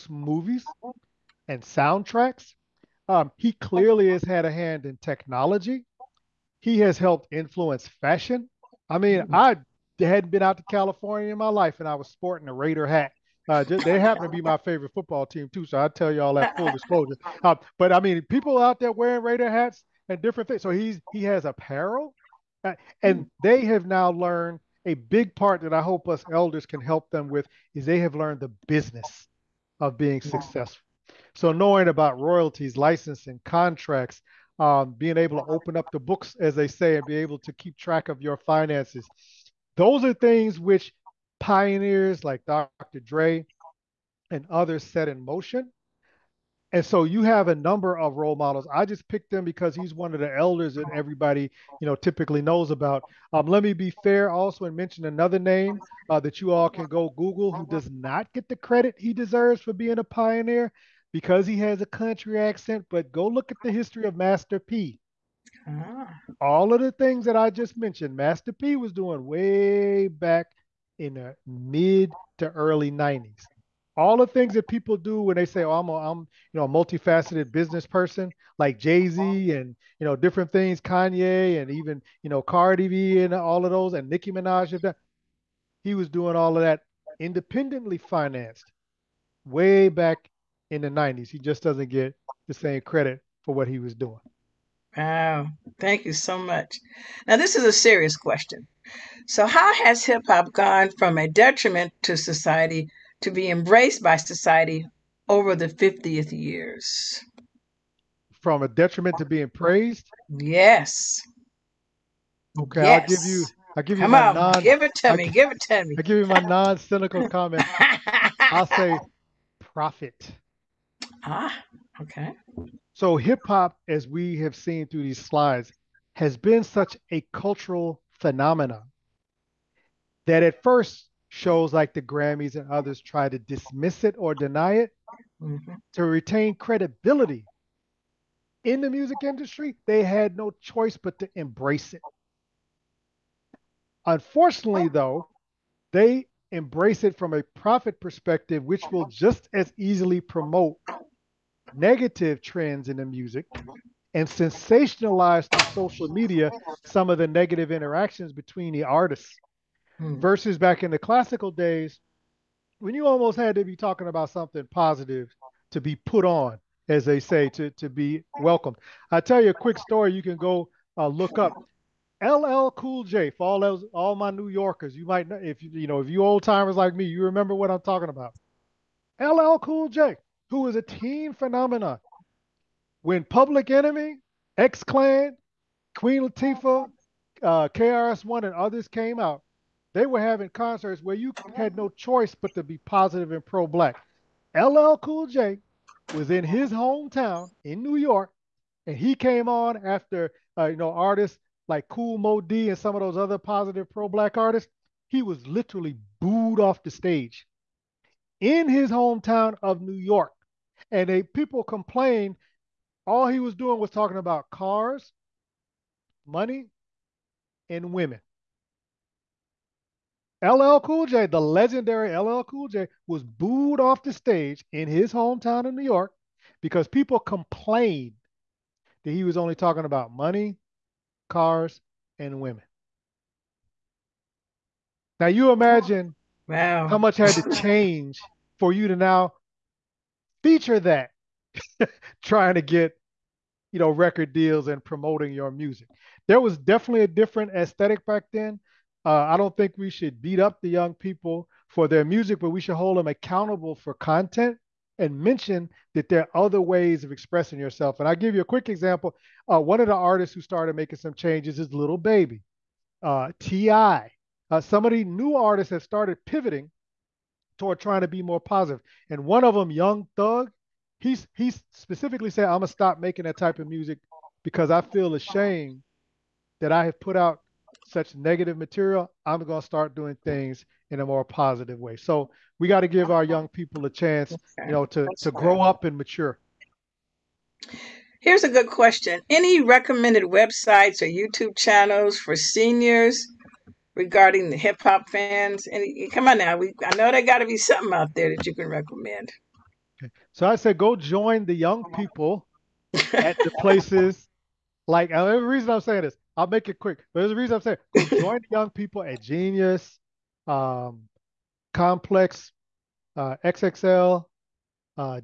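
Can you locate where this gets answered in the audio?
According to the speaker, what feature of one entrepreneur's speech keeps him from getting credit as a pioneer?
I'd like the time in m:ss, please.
1:01.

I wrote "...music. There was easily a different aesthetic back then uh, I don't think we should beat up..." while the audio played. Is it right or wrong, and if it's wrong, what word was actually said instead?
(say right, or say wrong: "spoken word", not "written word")
wrong: "definitely", not "easily".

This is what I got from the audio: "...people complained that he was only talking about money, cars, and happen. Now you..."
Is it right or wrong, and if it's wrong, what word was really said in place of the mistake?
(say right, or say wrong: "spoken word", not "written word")
wrong: "women", not "happen".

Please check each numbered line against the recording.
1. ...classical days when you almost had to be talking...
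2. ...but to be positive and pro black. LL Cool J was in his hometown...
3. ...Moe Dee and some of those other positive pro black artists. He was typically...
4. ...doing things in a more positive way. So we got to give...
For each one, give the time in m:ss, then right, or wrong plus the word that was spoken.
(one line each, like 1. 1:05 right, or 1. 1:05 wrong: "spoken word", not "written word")
1. 2:40 right
2. 3:12 right
3. 3:22 wrong: "literally", not "typically"
4. 4:39 right.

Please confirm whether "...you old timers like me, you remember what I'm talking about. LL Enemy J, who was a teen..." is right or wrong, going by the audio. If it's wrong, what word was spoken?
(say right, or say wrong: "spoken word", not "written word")
wrong: "Cool", not "Enemy".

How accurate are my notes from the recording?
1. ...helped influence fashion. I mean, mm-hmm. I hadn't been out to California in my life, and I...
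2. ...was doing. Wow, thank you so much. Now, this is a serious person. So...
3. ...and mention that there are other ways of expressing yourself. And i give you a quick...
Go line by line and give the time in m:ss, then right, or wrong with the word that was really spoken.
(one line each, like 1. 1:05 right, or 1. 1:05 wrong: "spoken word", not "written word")
1. 0:06 right
2. 1:33 wrong: "question", not "person"
3. 4:14 right.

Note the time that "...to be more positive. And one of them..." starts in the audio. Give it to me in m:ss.
4:28.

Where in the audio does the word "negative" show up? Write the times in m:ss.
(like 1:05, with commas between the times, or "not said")
2:31, 2:37, 4:38.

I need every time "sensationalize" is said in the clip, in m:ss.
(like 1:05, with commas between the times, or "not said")
2:34.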